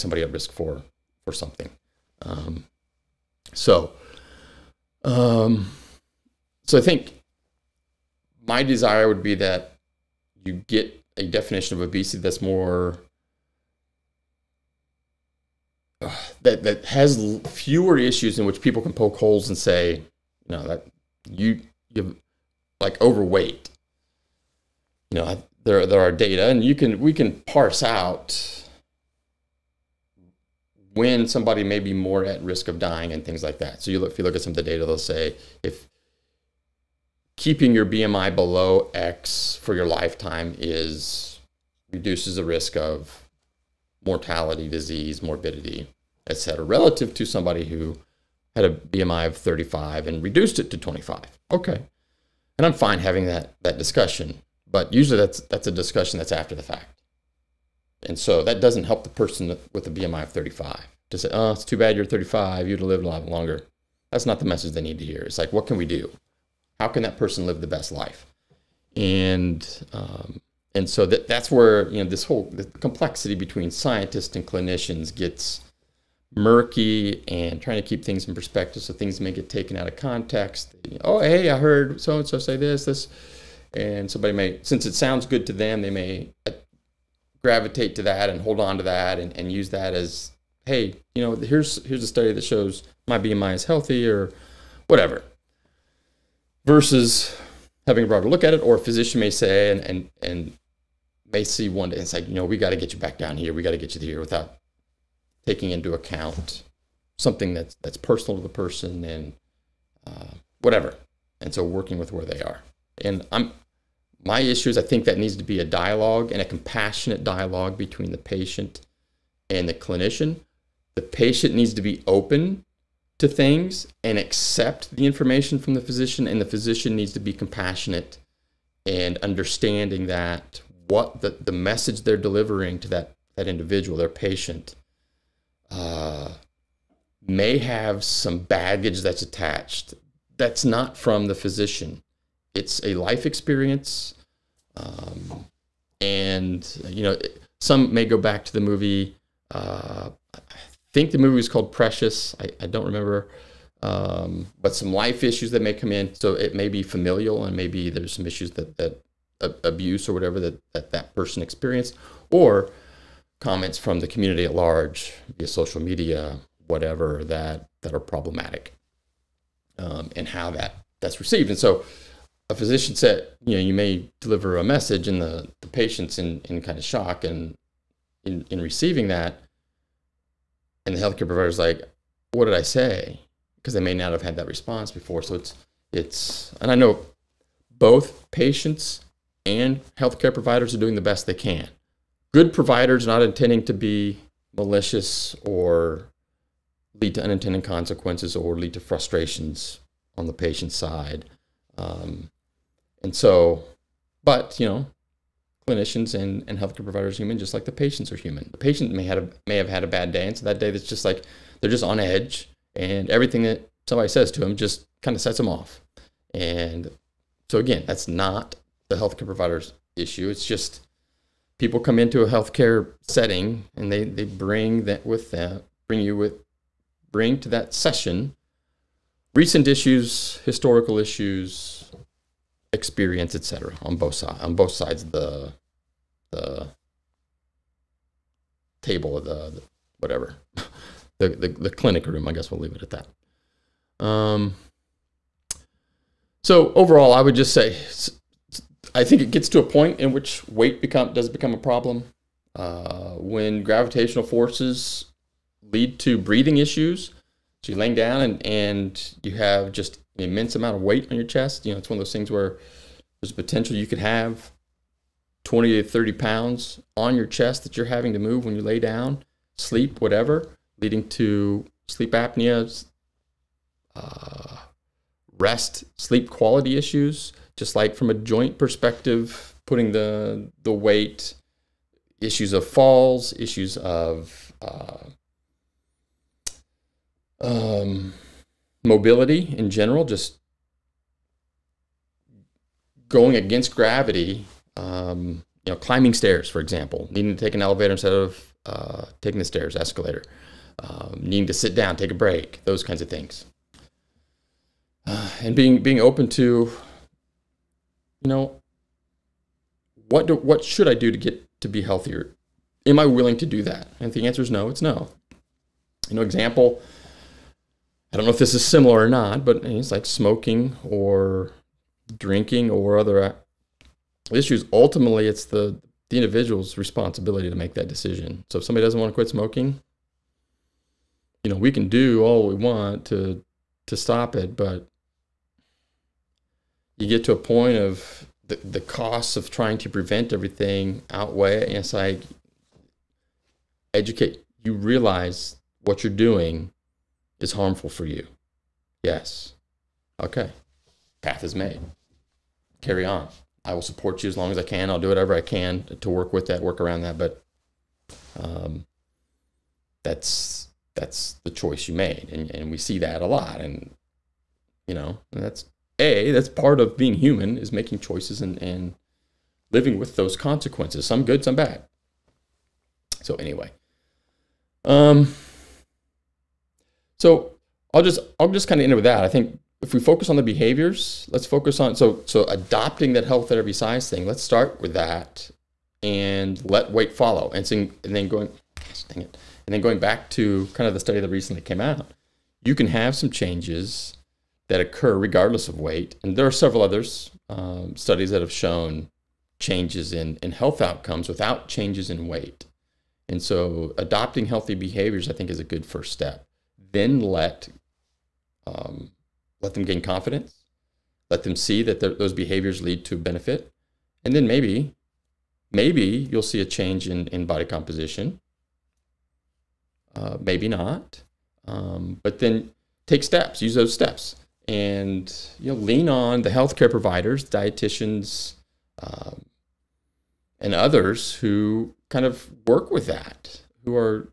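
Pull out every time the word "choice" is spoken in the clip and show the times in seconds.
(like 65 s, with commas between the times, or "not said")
361 s, 367 s.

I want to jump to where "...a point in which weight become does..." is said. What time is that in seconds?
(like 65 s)
249 s.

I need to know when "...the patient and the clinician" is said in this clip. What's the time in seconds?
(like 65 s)
118 s.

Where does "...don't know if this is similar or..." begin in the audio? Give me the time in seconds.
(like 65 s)
318 s.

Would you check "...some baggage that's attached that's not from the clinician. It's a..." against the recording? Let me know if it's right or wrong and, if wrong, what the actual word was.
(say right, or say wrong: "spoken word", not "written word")
wrong: "physician", not "clinician".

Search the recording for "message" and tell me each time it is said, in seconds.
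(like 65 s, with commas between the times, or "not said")
64 s, 131 s, 174 s.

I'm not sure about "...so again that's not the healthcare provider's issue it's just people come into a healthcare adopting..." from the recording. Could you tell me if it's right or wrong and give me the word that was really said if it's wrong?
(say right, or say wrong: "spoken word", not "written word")
wrong: "setting", not "adopting".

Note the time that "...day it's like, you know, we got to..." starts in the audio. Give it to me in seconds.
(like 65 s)
101 s.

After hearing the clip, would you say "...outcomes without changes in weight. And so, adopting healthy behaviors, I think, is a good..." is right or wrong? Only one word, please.
right.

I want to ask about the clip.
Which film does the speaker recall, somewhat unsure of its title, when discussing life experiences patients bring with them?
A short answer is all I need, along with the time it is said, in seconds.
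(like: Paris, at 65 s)
Precious, at 151 s.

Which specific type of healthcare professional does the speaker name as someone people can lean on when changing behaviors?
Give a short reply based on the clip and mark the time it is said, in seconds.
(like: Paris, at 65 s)
dietitians, at 427 s.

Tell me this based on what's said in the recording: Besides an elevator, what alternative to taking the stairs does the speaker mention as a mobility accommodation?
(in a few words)
escalator.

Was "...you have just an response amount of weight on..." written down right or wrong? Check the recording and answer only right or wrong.
wrong.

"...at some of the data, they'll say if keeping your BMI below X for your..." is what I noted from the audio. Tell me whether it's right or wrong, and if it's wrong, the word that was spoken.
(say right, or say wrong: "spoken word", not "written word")
right.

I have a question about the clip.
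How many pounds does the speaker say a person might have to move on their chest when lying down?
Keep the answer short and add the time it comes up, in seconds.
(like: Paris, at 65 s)
20 to 30, at 265 s.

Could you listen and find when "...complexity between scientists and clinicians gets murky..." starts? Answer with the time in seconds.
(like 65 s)
72 s.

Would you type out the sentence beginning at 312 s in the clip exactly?
Am I willing to do that?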